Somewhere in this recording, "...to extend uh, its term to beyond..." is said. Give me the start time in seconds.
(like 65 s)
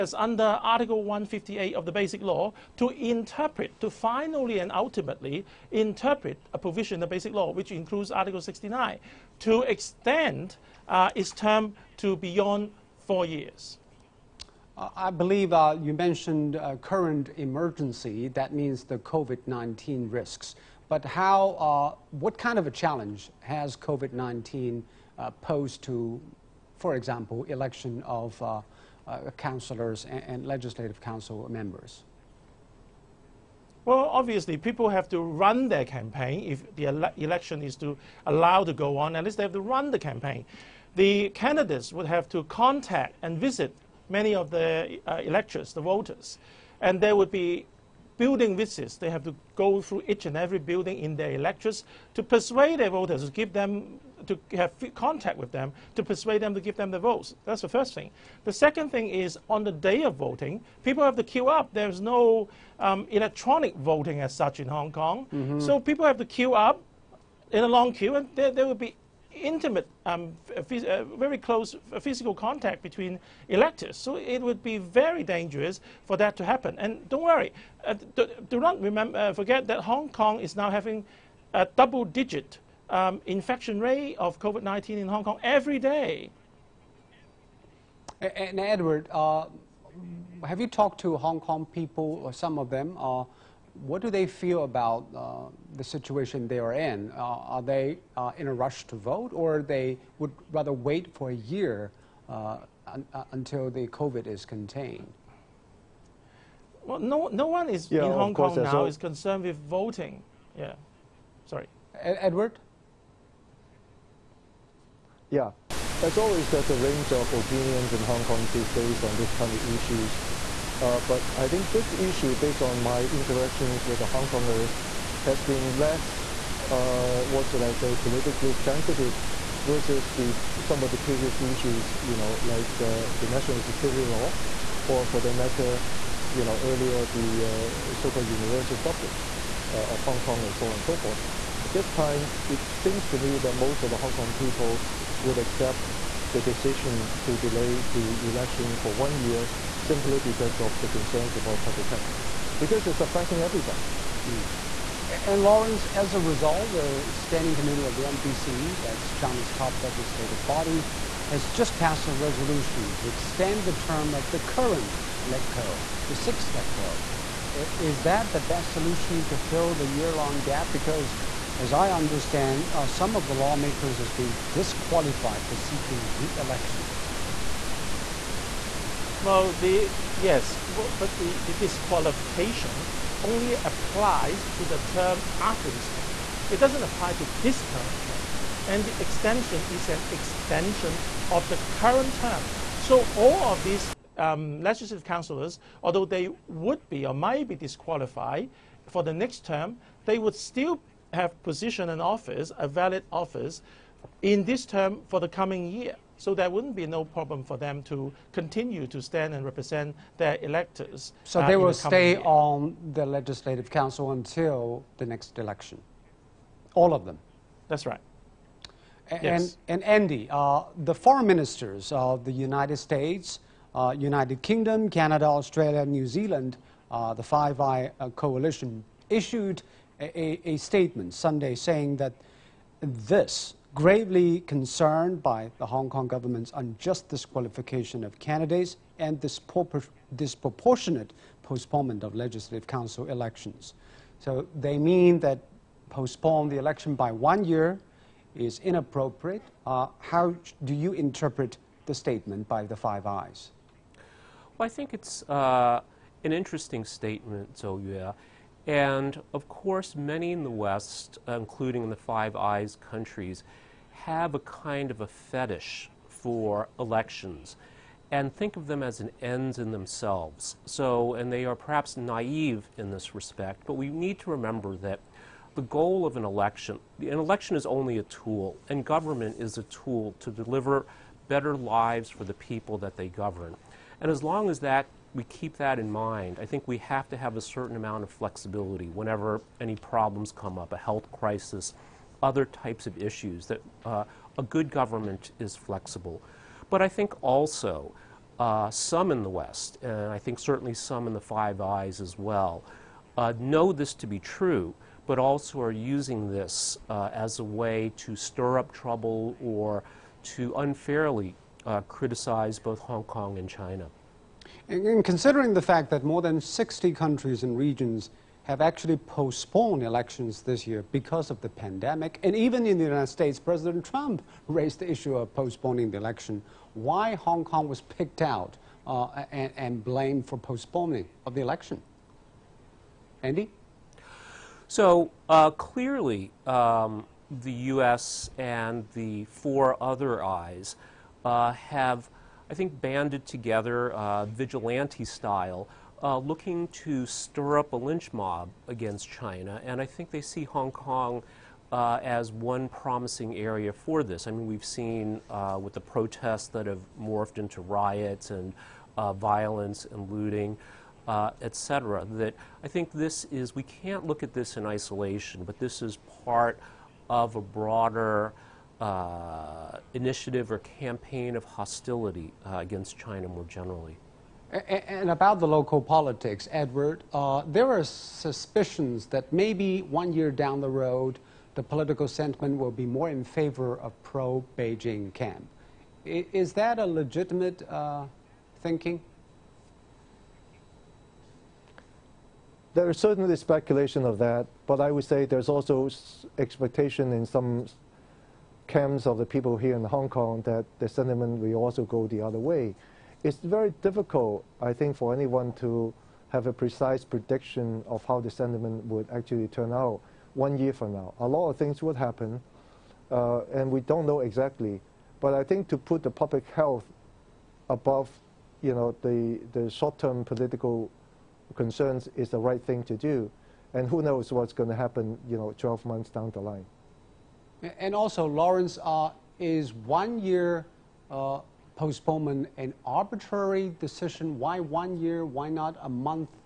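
9 s.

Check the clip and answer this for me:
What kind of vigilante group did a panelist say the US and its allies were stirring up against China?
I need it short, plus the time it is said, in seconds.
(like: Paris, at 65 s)
a lynch mob, at 347 s.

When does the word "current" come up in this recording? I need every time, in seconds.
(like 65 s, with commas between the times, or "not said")
16 s, 164 s, 187 s, 191 s.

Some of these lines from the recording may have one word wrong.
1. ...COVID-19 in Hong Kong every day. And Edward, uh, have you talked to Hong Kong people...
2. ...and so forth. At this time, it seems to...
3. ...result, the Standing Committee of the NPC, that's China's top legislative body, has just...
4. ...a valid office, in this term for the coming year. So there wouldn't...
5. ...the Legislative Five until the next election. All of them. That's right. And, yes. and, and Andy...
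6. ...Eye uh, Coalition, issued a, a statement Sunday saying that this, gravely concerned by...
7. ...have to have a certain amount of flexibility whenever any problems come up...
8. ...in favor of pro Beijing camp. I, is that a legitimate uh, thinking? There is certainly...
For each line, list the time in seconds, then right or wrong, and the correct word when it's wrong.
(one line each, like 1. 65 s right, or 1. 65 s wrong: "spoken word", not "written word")
1. 84 s right
2. 140 s right
3. 156 s right
4. 202 s right
5. 212 s wrong: "Council", not "Five"
6. 227 s right
7. 286 s right
8. 383 s right.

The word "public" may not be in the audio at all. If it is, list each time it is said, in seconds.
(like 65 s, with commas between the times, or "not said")
151 s, 416 s.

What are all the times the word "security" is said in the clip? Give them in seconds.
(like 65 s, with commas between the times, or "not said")
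133 s.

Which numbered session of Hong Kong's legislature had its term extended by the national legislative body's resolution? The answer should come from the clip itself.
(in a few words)
the sixth LegCo.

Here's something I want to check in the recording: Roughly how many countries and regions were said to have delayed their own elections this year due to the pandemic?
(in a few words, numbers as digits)
more than 60.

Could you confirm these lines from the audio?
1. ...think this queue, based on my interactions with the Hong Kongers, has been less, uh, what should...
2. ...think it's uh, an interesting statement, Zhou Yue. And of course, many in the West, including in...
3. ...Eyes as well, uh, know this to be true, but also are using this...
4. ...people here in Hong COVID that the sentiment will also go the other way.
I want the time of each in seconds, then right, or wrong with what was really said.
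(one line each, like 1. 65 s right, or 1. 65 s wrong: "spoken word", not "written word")
1. 121 s wrong: "issue", not "queue"
2. 254 s right
3. 301 s right
4. 399 s wrong: "Kong", not "COVID".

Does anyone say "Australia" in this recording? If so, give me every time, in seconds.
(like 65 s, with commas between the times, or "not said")
225 s.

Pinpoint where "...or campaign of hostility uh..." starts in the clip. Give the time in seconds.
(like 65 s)
370 s.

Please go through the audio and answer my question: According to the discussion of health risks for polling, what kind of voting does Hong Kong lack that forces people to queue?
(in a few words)
electronic voting.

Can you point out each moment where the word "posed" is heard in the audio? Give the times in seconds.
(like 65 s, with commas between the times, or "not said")
25 s.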